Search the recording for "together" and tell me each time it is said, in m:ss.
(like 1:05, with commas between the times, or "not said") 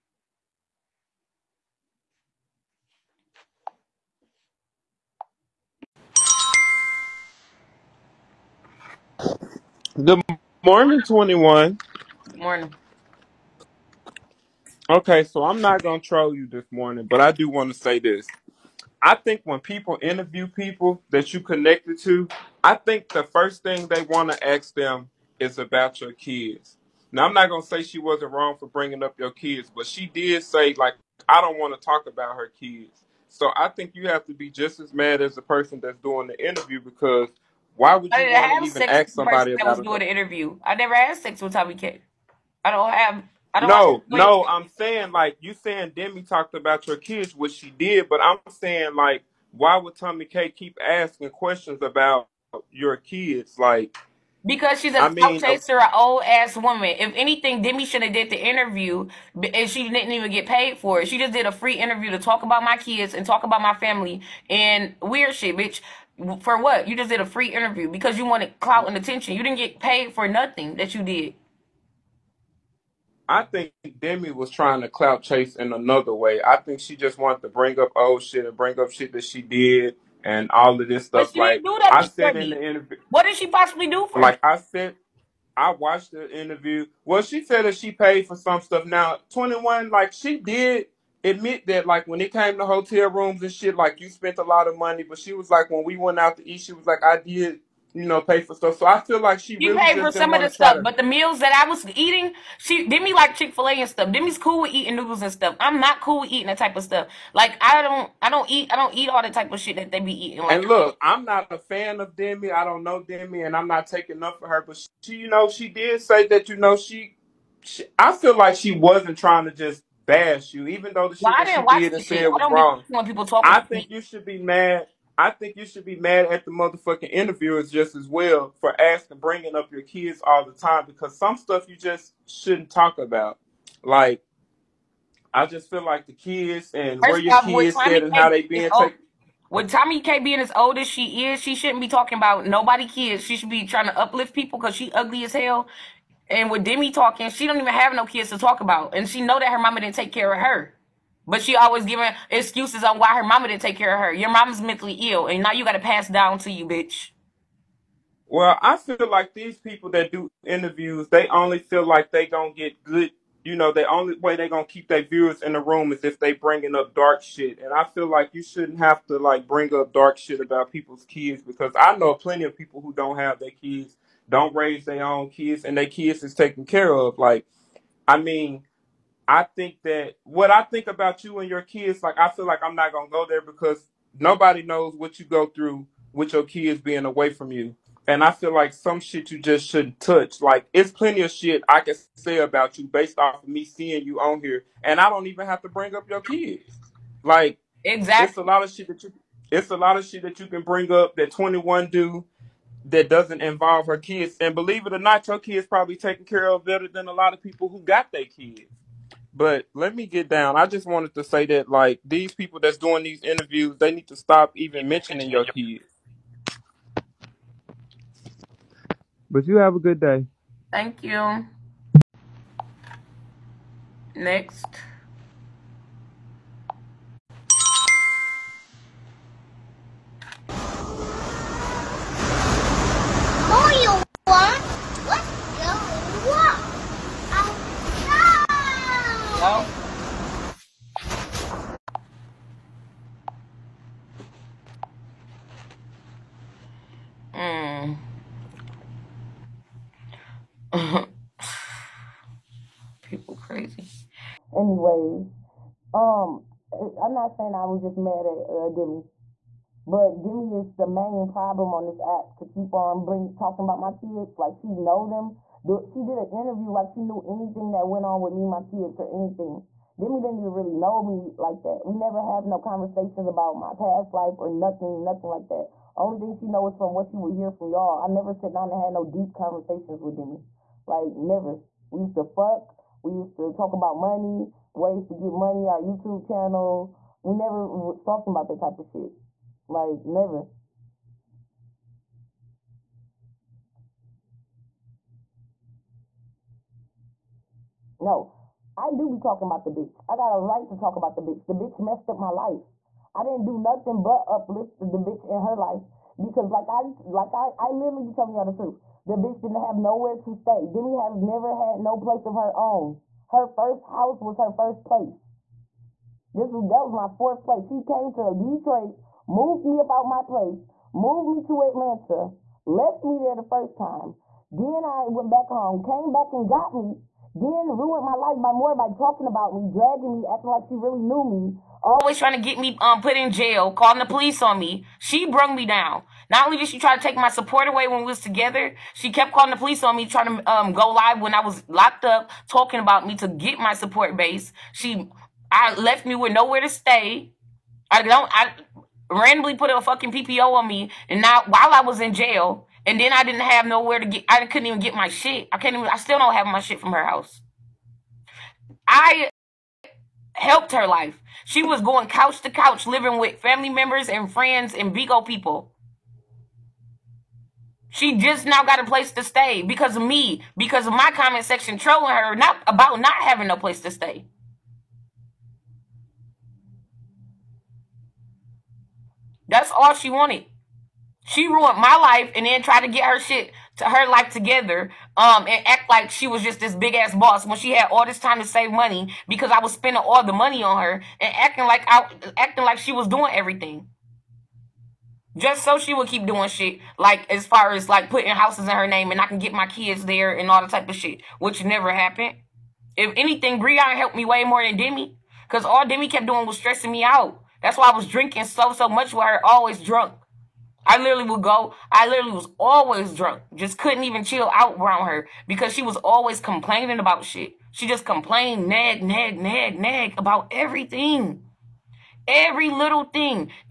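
5:38, 6:24.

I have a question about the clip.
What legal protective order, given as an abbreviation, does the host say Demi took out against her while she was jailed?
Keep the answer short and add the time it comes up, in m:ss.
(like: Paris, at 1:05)
PPO, at 5:50.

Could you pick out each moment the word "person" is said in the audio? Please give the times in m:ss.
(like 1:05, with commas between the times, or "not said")
0:35, 0:39.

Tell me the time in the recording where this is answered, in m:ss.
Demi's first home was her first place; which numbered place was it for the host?
5:17.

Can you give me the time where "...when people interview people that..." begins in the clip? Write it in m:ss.
0:19.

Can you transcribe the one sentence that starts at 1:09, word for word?
You didn't get paid for nothing that you did.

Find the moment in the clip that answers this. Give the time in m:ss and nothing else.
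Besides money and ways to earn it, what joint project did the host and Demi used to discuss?
4:45.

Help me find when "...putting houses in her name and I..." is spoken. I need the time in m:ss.
6:38.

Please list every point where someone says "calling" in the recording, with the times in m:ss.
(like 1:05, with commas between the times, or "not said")
5:33, 5:39.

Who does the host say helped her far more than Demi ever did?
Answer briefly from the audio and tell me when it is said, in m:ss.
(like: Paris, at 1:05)
Brianna, at 6:43.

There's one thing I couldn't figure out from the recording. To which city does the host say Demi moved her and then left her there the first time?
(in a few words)
Atlanta.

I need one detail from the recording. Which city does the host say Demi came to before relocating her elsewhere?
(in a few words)
Detroit.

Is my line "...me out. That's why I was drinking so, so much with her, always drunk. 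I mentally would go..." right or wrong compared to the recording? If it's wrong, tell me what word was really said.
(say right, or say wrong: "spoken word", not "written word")
wrong: "literally", not "mentally".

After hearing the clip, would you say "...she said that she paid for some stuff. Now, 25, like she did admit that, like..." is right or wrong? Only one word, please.
wrong.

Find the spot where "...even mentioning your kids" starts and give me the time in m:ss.
3:34.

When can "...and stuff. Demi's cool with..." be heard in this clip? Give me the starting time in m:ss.
1:43.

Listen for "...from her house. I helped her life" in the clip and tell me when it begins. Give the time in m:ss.
5:56.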